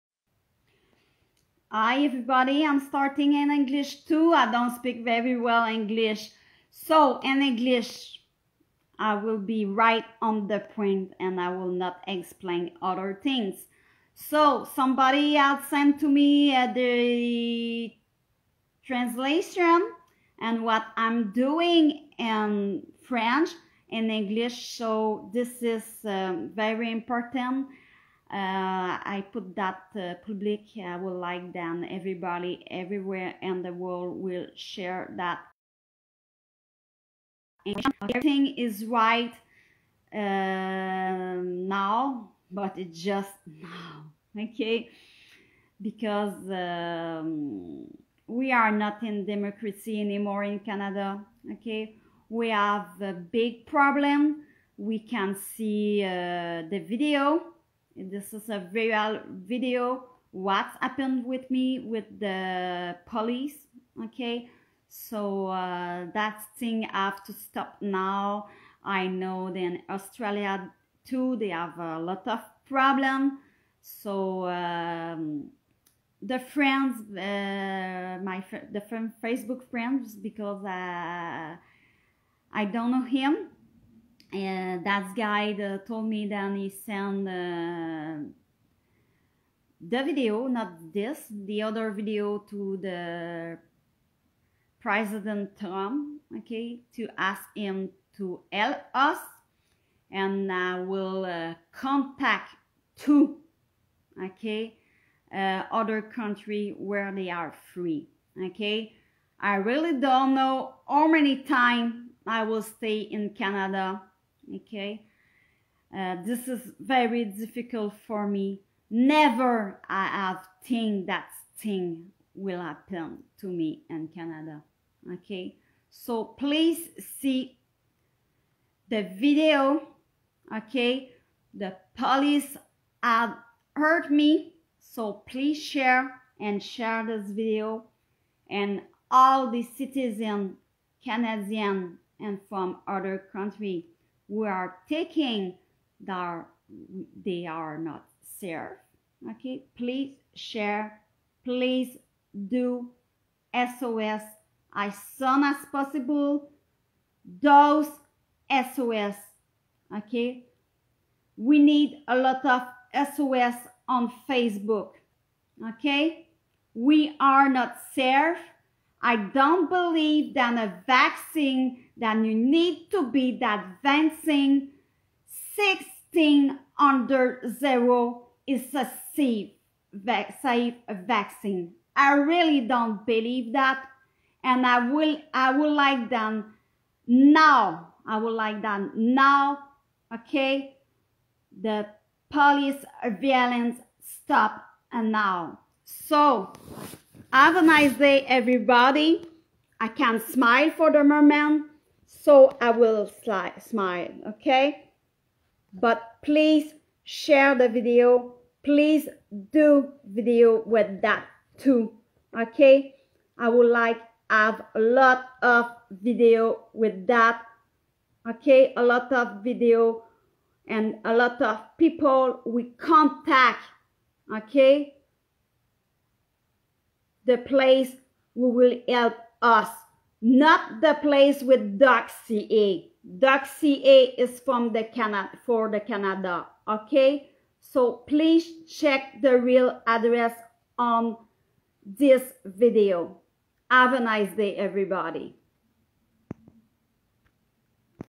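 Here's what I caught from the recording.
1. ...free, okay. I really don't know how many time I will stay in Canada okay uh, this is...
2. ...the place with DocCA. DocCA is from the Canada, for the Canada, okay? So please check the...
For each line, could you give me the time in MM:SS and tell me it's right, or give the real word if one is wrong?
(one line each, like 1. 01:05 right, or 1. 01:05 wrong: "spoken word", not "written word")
1. 01:47 right
2. 03:50 right.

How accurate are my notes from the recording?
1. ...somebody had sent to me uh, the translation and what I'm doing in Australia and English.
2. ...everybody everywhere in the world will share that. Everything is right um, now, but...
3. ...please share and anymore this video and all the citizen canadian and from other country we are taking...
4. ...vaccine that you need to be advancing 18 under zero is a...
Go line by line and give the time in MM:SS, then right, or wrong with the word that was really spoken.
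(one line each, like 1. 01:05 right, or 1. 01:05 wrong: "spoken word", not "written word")
1. 00:14 wrong: "French", not "Australia"
2. 00:31 right
3. 02:15 wrong: "share", not "anymore"
4. 02:50 wrong: "16", not "18".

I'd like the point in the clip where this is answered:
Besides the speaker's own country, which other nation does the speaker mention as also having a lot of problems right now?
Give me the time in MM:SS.
01:09.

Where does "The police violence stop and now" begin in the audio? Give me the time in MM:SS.
03:11.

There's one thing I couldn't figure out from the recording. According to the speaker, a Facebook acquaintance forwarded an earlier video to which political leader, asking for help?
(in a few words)
President Trump.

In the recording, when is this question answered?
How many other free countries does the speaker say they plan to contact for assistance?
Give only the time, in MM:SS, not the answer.
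01:42.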